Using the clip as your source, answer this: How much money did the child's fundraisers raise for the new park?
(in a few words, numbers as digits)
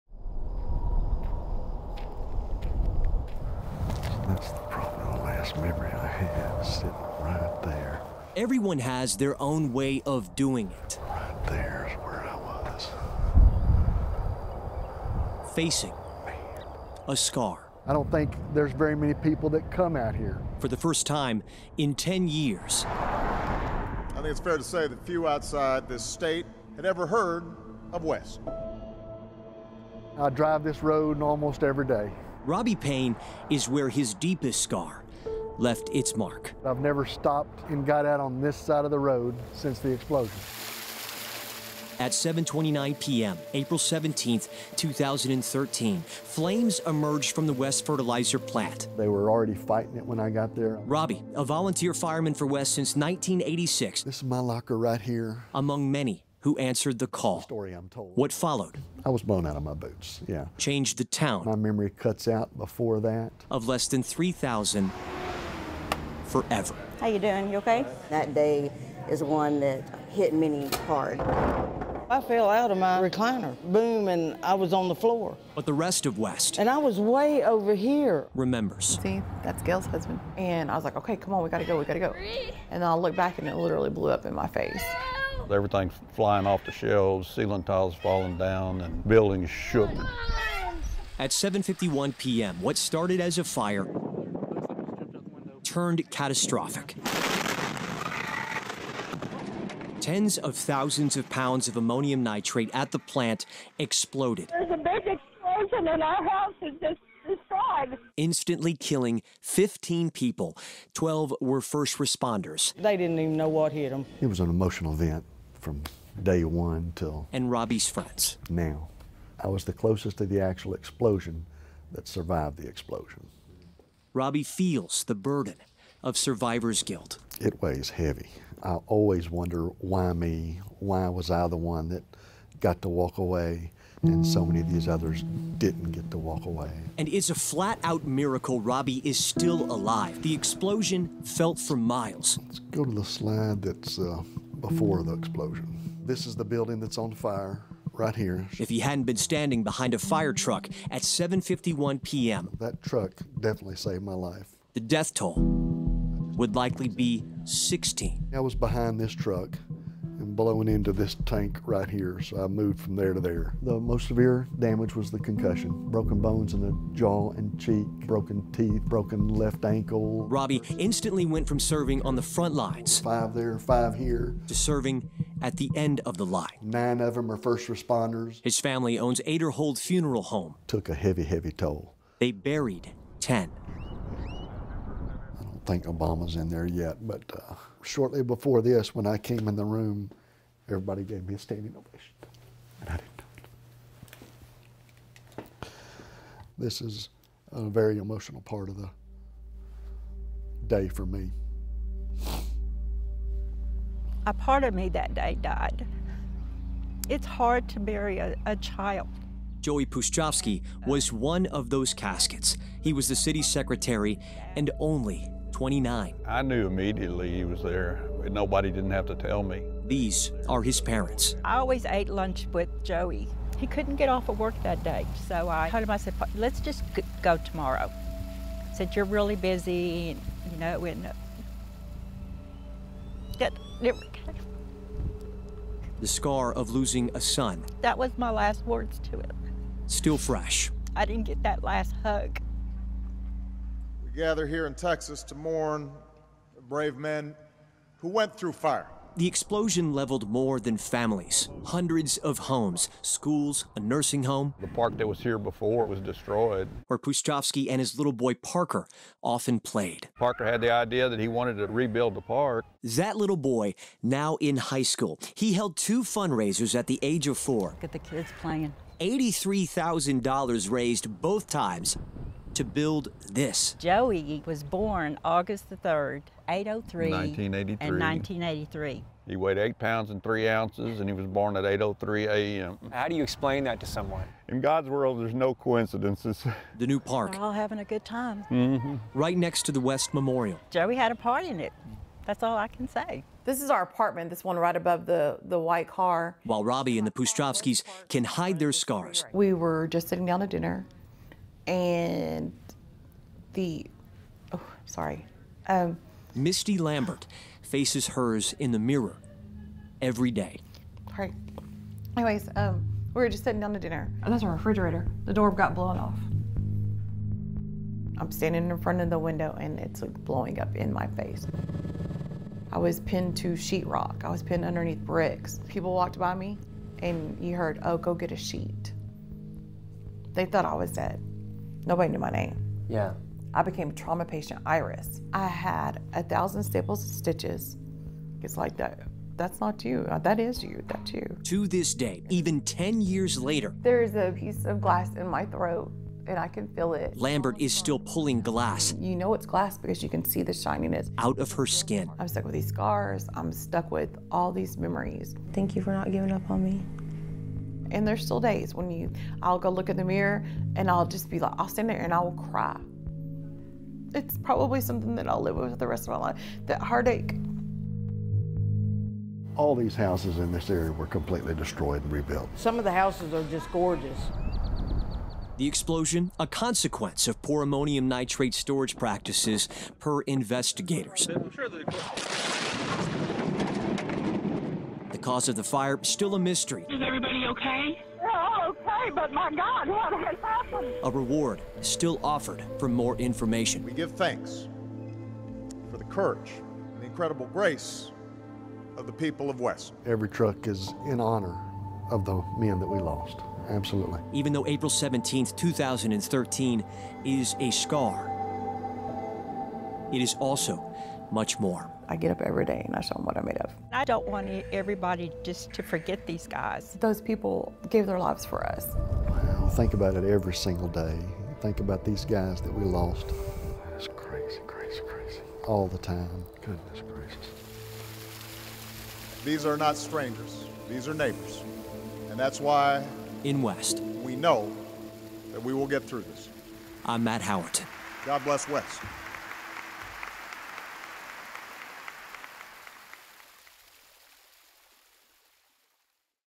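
$83,000.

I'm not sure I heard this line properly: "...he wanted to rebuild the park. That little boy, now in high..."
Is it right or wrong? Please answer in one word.
right.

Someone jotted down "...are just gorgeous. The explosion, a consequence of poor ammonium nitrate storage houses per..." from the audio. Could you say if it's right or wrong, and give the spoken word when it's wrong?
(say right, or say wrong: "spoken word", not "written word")
wrong: "practices", not "houses".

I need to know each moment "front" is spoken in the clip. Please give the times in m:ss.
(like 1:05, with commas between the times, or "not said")
2:52, 5:18.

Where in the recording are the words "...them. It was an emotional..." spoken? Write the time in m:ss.
1:53.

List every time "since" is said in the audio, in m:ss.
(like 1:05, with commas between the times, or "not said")
0:39, 0:52.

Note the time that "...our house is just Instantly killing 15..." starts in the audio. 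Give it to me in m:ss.
1:46.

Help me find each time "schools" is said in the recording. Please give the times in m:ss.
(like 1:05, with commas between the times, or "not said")
4:13, 4:24.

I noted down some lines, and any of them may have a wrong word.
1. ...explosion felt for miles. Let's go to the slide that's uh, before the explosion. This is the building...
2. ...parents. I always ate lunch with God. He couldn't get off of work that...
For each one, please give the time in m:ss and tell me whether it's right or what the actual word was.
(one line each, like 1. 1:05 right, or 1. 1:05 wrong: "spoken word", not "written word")
1. 2:20 right
2. 3:40 wrong: "Joey", not "God".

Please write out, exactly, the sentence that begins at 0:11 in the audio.
Right there is where I was.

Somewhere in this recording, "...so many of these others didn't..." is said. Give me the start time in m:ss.
2:14.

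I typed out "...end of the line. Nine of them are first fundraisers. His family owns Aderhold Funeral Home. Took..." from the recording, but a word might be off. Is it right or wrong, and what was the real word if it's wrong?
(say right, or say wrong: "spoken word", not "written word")
wrong: "responders", not "fundraisers".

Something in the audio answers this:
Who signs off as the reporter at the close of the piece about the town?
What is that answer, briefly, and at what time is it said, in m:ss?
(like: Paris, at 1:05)
Matt Howerton, at 7:17.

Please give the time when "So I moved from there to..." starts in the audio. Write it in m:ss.
2:42.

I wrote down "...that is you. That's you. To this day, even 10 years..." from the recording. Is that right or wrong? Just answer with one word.
right.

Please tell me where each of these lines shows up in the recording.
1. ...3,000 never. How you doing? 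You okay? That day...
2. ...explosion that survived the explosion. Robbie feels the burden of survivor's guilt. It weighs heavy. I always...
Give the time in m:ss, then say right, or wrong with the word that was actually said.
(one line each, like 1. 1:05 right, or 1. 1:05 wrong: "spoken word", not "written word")
1. 1:04 wrong: "forever", not "never"
2. 2:00 right.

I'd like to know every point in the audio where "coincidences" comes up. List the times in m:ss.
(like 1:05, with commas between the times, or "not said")
4:45.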